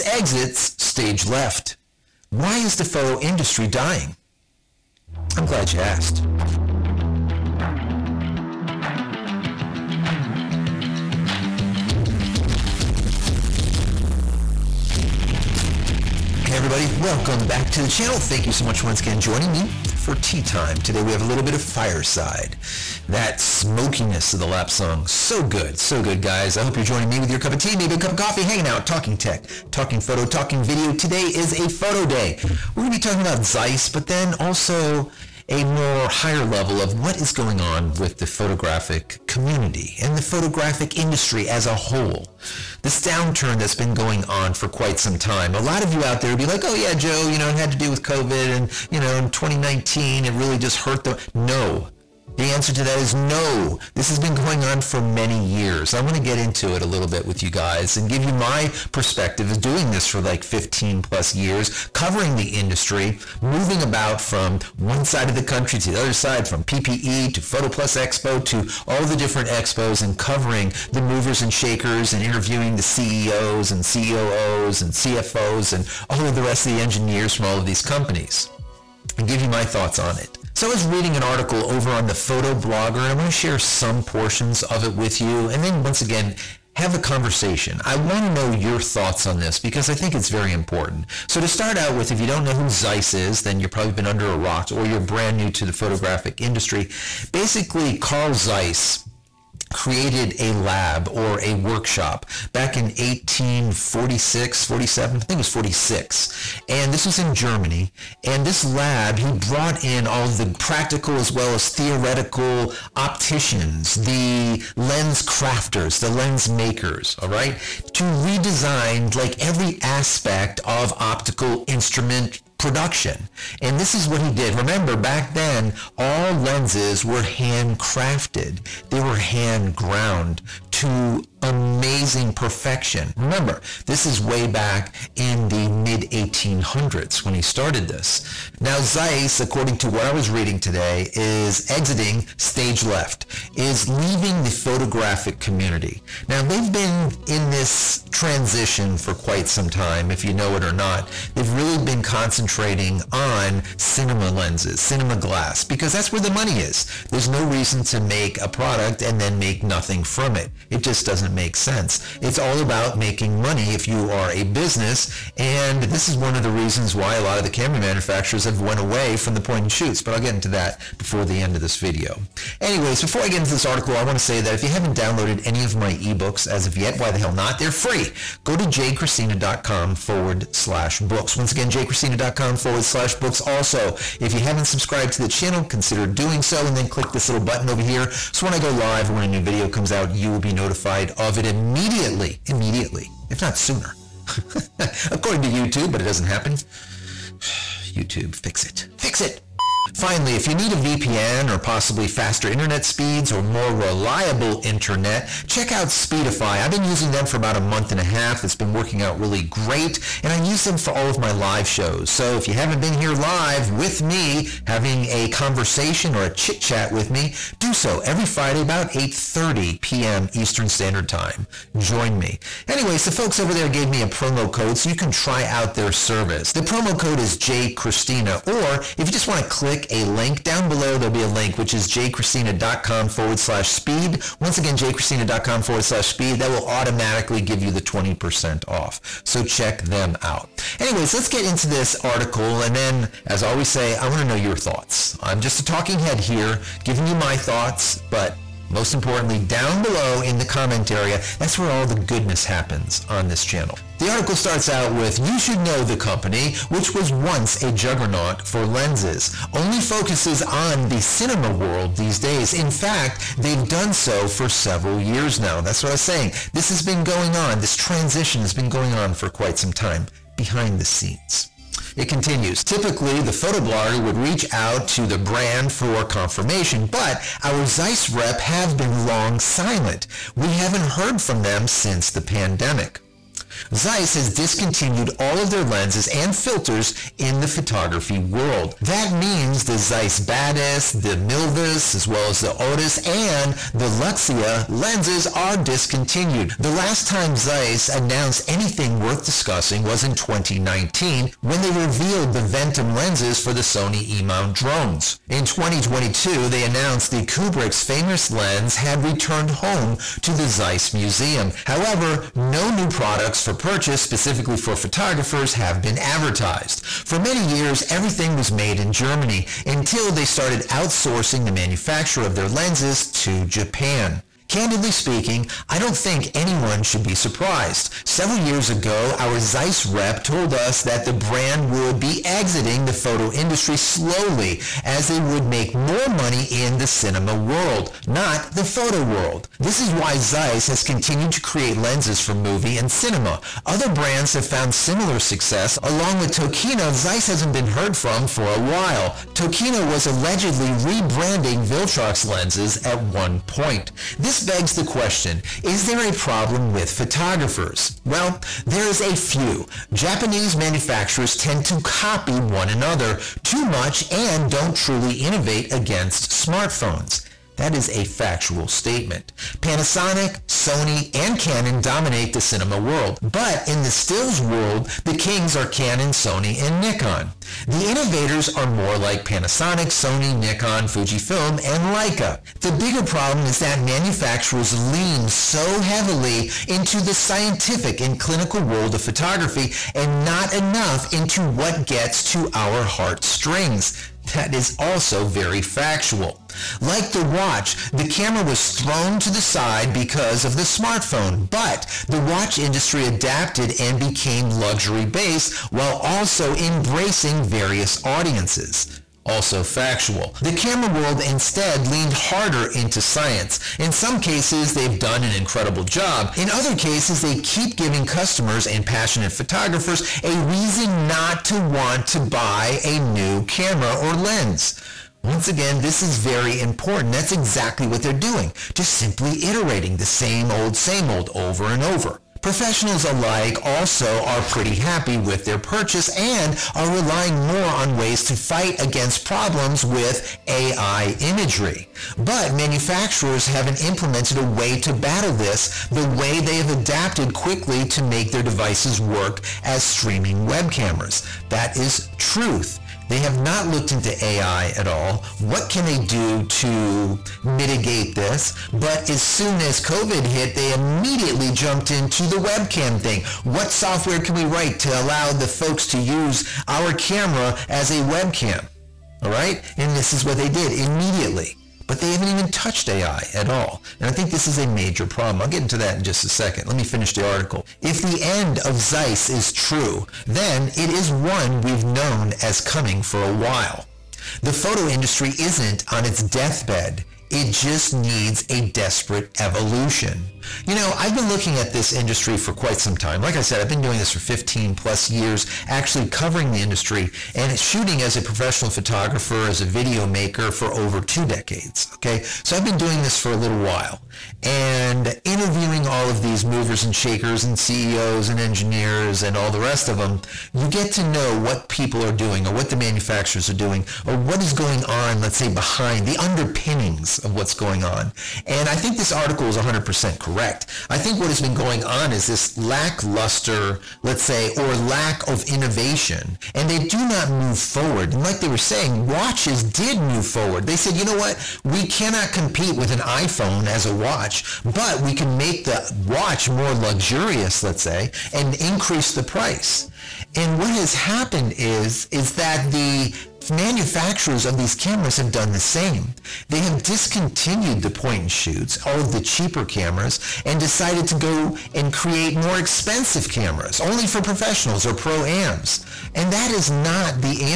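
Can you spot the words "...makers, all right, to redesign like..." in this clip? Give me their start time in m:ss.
1:56.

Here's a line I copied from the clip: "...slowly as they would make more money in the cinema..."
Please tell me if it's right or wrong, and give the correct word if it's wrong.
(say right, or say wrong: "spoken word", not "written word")
right.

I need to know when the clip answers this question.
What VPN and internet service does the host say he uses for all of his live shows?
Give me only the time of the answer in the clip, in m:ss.
3:25.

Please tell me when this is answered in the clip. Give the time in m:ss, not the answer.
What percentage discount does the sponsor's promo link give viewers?
3:57.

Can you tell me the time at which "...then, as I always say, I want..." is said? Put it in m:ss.
4:02.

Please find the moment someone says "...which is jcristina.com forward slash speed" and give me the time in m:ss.
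3:51.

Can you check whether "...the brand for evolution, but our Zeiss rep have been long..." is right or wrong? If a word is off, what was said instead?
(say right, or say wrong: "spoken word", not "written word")
wrong: "confirmation", not "evolution".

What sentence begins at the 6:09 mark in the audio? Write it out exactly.
Panasonic, Sony, and Canon dominate the cinema world.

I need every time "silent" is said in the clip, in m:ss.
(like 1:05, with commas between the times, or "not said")
4:39.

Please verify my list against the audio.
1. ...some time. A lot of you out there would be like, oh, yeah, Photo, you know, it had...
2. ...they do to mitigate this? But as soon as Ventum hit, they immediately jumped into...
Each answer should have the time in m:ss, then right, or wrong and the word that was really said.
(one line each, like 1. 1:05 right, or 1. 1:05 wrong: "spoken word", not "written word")
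1. 0:44 wrong: "Joe", not "Photo"
2. 7:35 wrong: "COVID", not "Ventum".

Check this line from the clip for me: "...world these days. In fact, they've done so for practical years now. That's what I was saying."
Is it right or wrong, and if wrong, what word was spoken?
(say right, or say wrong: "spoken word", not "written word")
wrong: "several", not "practical".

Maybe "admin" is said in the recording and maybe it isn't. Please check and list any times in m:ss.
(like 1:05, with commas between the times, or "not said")
not said.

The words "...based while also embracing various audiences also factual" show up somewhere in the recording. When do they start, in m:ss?
6:45.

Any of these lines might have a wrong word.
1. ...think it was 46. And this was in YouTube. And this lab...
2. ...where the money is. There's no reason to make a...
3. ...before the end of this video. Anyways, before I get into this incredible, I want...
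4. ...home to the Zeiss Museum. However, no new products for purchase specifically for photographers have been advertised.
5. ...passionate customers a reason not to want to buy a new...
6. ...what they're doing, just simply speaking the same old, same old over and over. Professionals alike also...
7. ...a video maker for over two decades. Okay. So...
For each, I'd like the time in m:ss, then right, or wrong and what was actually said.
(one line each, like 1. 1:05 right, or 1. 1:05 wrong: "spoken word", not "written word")
1. 1:45 wrong: "Germany", not "YouTube"
2. 2:36 right
3. 2:50 wrong: "article", not "incredible"
4. 5:09 right
5. 6:58 wrong: "photographers", not "customers"
6. 7:07 wrong: "iterating", not "speaking"
7. 8:19 right.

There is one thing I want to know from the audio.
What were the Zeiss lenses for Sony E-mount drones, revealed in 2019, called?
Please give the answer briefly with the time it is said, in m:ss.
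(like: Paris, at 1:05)
Ventum, at 5:02.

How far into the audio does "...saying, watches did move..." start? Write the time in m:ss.
8:48.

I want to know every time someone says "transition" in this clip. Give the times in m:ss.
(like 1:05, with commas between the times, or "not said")
2:28, 4:27.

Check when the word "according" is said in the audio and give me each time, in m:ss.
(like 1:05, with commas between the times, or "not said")
2:19, 3:15.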